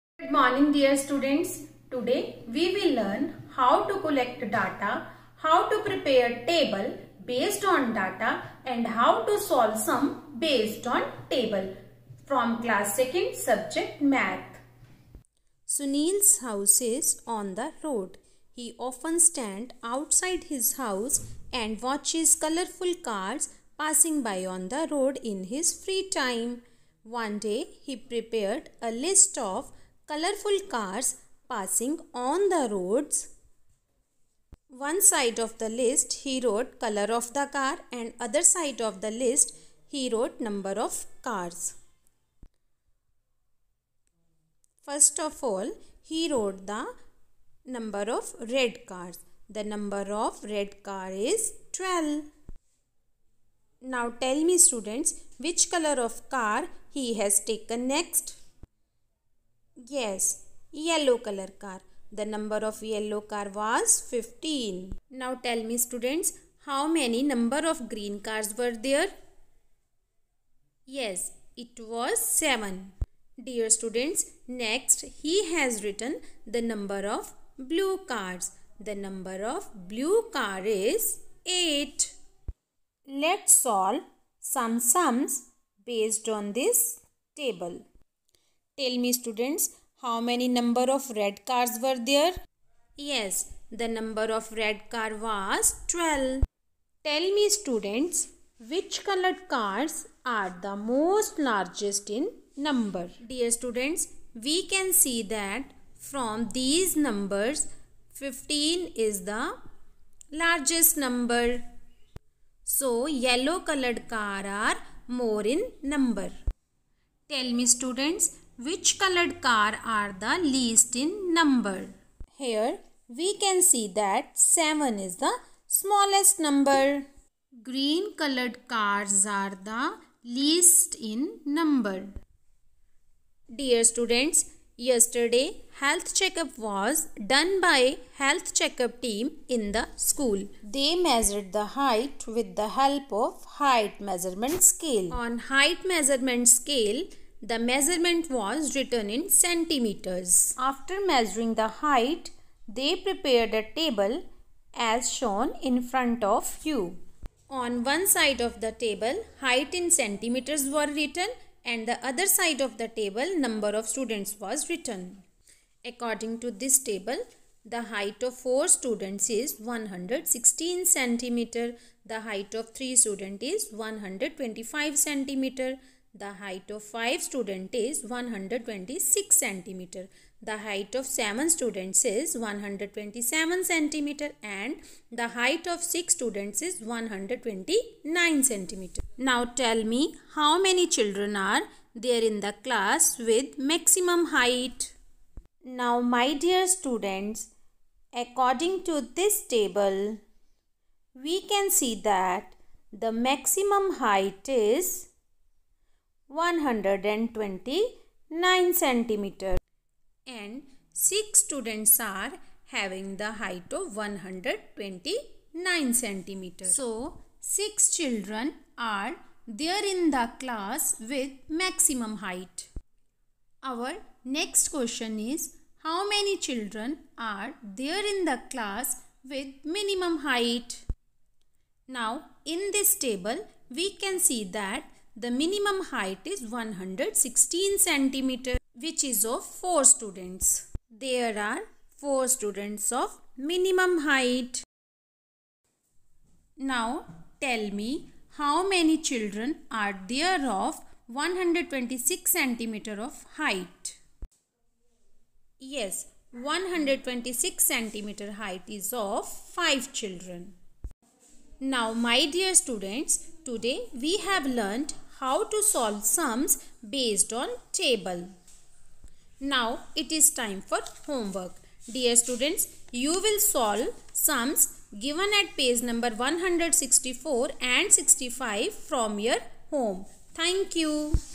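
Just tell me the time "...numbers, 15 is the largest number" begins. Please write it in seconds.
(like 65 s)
106 s.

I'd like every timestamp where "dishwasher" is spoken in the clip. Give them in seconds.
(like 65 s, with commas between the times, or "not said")
not said.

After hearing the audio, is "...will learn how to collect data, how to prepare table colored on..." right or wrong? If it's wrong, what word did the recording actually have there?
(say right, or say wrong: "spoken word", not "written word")
wrong: "based", not "colored".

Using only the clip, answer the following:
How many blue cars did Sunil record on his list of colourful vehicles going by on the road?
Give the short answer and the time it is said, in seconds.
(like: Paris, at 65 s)
8, at 81 s.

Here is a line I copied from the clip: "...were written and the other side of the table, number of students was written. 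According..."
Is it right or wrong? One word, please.
right.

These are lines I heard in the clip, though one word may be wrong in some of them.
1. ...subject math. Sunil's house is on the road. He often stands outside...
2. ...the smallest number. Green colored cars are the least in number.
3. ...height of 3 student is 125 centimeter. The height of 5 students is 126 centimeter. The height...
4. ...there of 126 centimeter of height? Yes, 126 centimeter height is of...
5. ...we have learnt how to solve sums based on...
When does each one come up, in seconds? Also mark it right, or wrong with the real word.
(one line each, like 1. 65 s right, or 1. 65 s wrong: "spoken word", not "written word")
1. 13 s right
2. 125 s right
3. 172 s right
4. 250 s right
5. 263 s right.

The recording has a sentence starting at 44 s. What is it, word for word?
First of all he wrote the number of red cars.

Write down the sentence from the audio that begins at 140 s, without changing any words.
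They measured the height with the help of height measurement scale.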